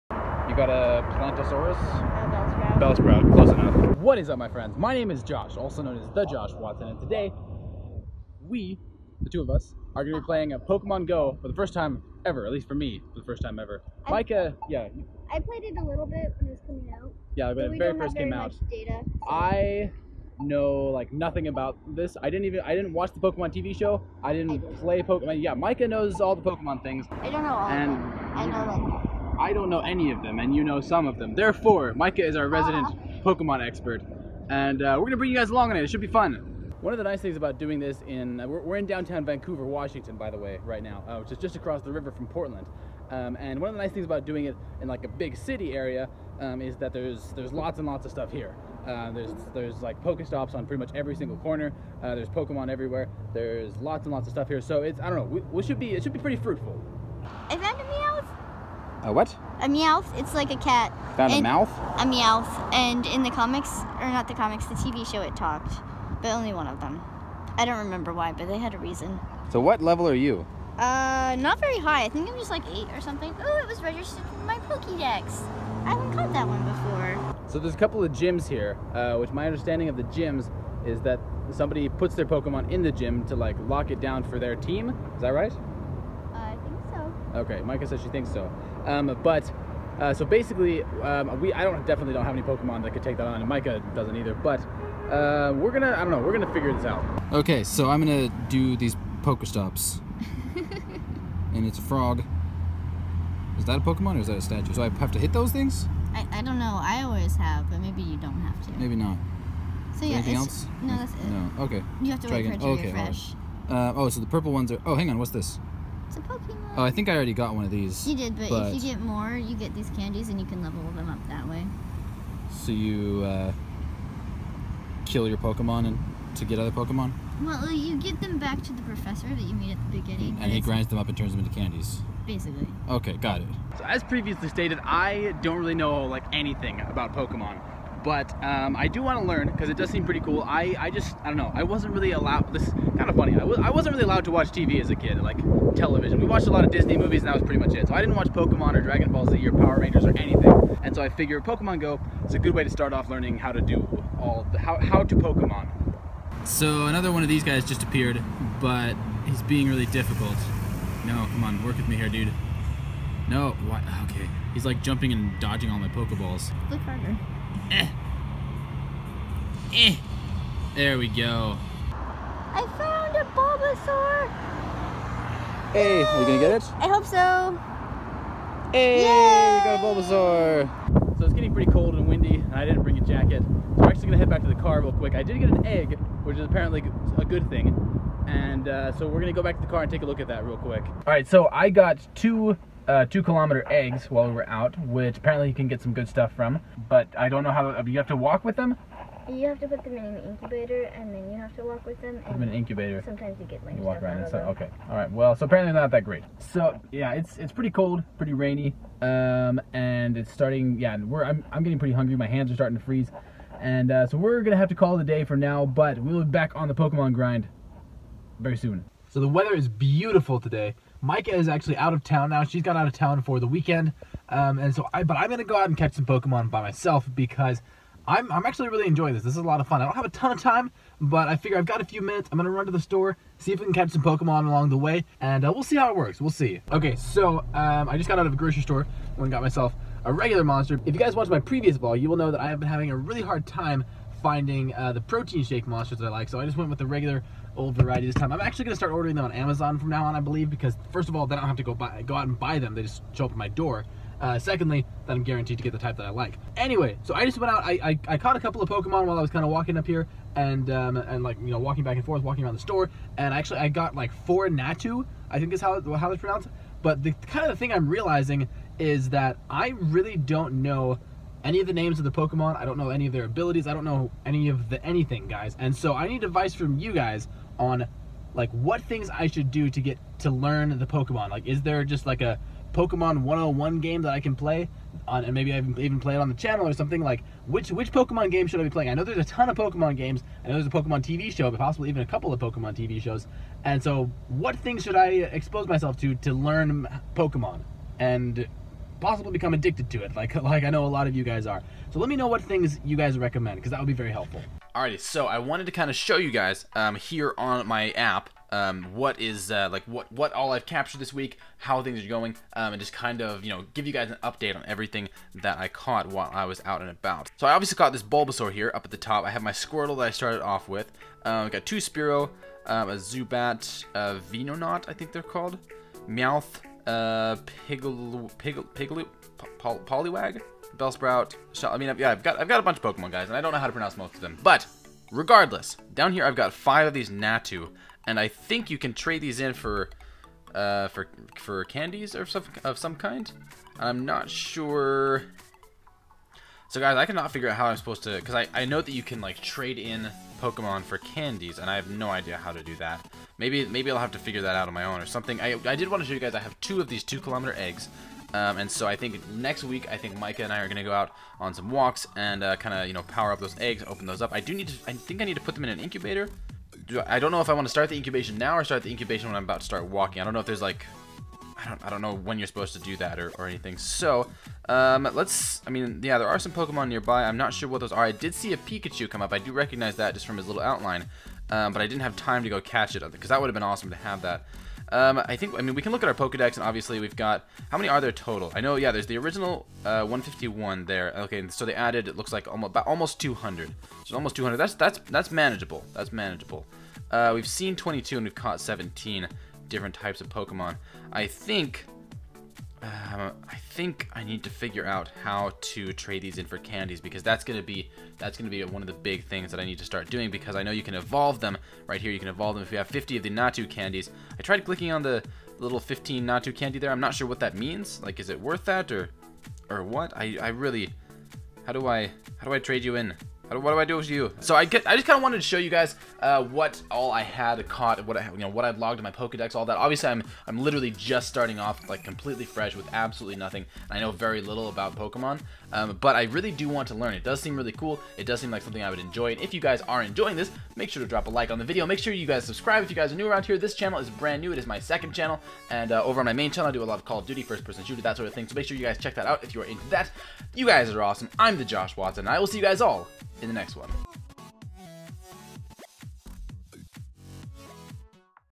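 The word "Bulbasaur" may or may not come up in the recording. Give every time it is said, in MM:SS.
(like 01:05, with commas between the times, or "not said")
02:53, 02:59, 05:18.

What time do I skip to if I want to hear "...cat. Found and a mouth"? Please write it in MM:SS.
01:00.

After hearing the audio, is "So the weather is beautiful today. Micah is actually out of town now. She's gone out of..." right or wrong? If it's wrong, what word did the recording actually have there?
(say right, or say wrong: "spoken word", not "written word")
right.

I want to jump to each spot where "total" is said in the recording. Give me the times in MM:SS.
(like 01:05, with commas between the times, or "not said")
06:28.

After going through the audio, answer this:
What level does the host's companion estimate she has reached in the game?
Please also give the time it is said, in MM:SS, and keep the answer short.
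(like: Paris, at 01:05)
8, at 01:12.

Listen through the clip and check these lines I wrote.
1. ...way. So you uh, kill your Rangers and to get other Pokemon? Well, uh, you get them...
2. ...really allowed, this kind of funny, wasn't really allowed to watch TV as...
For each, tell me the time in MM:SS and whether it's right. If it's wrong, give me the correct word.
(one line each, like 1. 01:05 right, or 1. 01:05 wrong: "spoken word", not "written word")
1. 02:01 wrong: "Pokemon", not "Rangers"
2. 02:21 right.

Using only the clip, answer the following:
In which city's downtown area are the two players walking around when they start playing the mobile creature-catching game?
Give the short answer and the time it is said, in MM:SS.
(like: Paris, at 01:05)
Vancouver, Washington, at 00:39.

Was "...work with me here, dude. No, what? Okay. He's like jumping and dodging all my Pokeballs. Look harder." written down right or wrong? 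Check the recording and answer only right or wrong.
right.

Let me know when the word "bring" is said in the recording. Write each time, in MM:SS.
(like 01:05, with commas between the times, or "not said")
00:35, 03:02.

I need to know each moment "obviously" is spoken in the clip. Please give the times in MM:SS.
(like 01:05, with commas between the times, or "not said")
05:17, 06:26, 07:09.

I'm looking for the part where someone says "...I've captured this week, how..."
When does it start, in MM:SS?
05:10.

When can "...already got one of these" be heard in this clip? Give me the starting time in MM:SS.
01:57.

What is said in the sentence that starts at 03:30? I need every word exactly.
Yeah, we're I'm I'm getting pretty hungry.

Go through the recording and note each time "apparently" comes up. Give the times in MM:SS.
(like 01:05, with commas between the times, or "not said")
03:06, 03:15, 03:25.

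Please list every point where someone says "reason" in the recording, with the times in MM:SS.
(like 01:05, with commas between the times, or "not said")
01:08.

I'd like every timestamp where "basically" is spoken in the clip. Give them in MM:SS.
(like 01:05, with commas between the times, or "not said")
01:30, 02:12.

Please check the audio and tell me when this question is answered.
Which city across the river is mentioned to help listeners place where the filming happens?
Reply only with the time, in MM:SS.
00:42.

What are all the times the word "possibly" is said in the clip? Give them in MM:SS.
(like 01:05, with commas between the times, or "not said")
04:51, 04:59.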